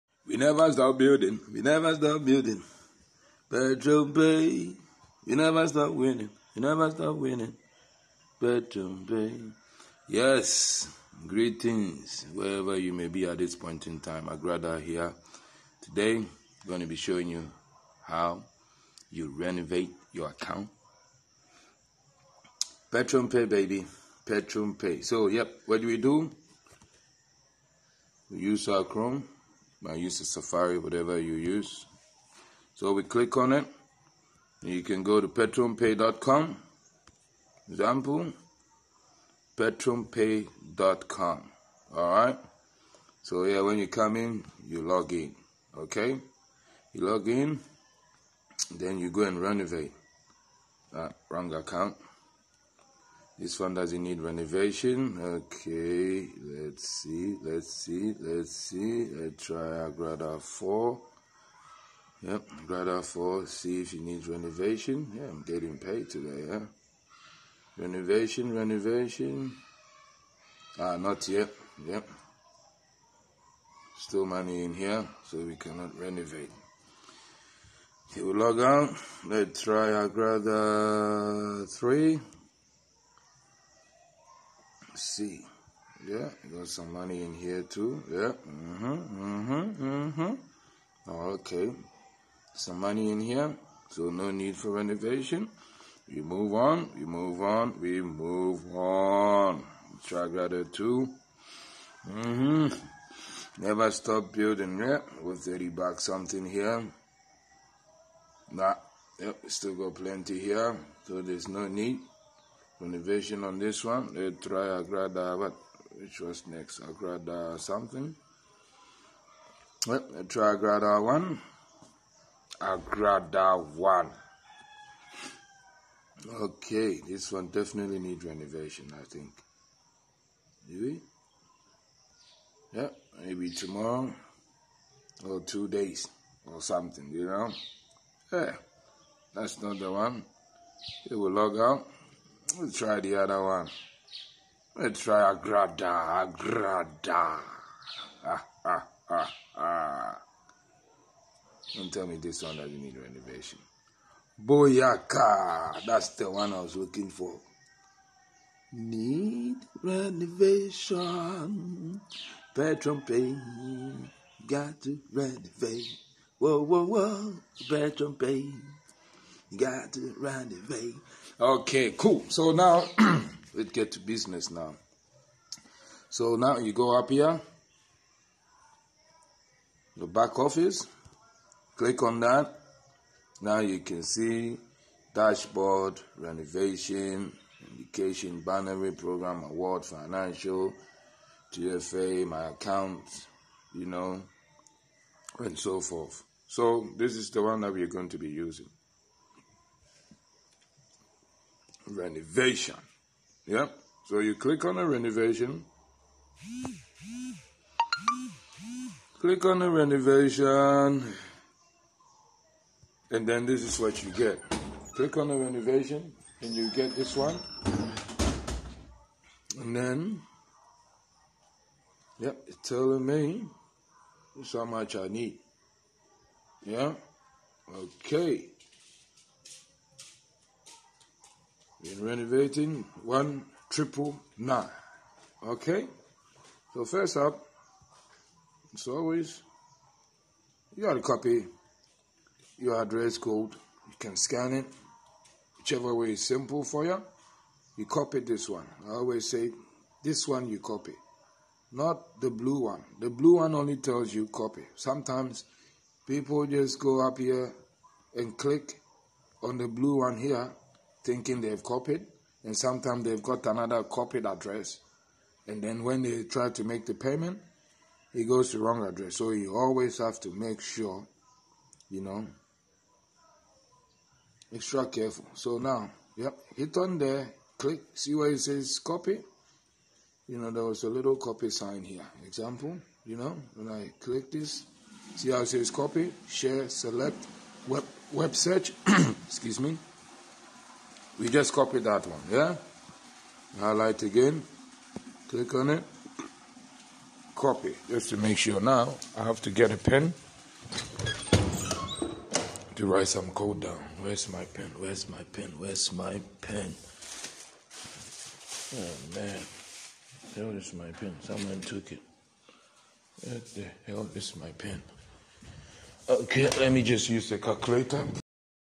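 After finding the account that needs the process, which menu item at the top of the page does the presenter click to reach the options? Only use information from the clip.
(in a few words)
back office.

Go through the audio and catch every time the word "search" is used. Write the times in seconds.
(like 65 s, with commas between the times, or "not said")
288 s.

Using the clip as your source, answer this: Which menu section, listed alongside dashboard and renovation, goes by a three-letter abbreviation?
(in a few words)
TFA.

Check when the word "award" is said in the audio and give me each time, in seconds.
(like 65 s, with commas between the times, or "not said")
189 s.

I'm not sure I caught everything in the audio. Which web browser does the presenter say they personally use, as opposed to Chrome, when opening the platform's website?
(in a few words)
Safari.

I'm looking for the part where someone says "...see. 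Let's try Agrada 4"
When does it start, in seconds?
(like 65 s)
58 s.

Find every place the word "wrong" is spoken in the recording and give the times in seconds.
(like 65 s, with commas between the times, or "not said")
51 s, 268 s.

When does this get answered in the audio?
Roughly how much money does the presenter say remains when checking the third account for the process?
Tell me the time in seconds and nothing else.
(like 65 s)
105 s.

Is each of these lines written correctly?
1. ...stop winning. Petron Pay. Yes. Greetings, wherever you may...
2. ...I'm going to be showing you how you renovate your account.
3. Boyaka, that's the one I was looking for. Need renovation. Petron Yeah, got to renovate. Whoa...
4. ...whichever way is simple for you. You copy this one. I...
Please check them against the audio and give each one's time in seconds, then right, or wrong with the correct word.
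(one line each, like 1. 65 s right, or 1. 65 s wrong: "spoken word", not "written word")
1. 6 s right
2. 16 s right
3. 154 s wrong: "Payne", not "Yeah"
4. 245 s right.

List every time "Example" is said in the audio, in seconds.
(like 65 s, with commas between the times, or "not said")
37 s, 282 s.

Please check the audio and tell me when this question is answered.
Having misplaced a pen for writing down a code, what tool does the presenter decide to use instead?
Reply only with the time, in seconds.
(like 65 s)
317 s.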